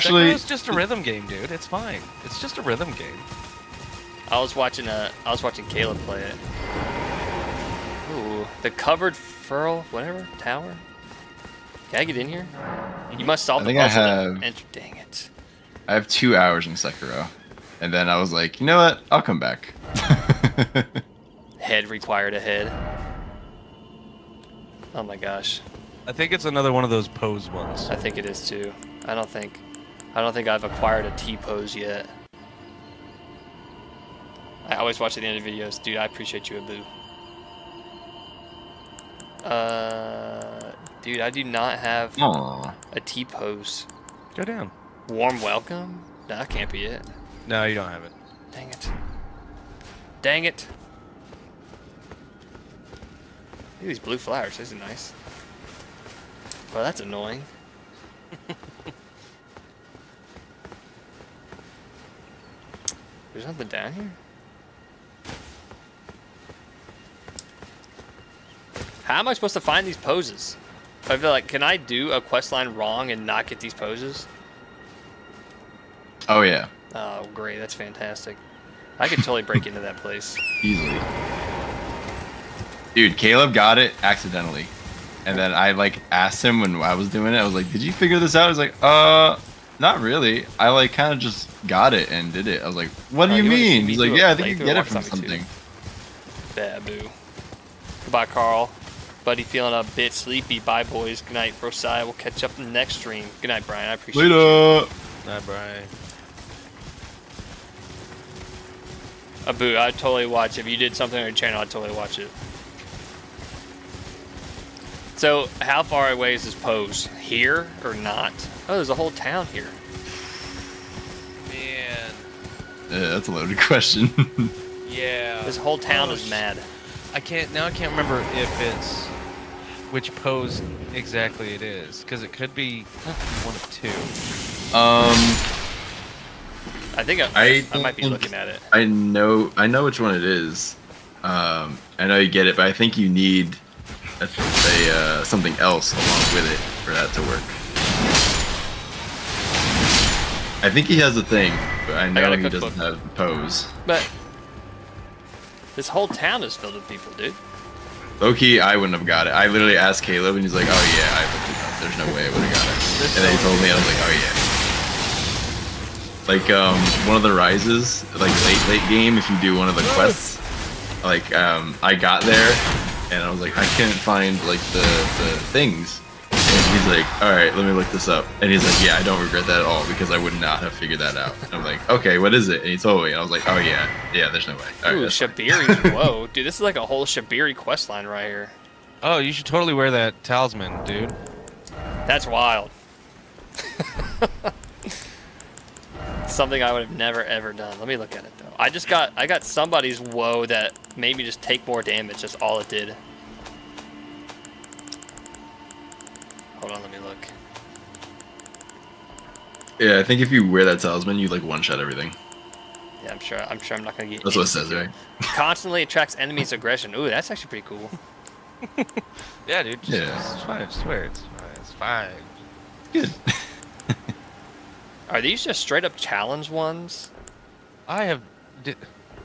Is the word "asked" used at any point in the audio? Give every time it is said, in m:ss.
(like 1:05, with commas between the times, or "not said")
1:26, 2:39.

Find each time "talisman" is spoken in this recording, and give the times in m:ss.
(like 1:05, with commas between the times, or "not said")
3:10, 3:30.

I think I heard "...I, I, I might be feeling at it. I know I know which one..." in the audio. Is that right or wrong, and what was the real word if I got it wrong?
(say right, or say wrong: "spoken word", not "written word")
wrong: "looking", not "feeling".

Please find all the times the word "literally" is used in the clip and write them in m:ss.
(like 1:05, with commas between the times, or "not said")
2:39.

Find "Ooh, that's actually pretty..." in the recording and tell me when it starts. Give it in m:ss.
3:36.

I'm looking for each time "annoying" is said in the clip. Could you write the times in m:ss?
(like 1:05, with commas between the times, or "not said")
0:56.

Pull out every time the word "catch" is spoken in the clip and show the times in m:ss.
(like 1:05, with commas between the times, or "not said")
1:42.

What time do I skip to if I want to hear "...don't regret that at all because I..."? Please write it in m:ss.
2:59.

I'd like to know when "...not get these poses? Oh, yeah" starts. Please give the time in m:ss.
1:13.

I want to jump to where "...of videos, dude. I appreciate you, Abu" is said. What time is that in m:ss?
0:35.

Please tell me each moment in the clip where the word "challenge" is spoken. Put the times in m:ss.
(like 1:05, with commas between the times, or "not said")
3:45.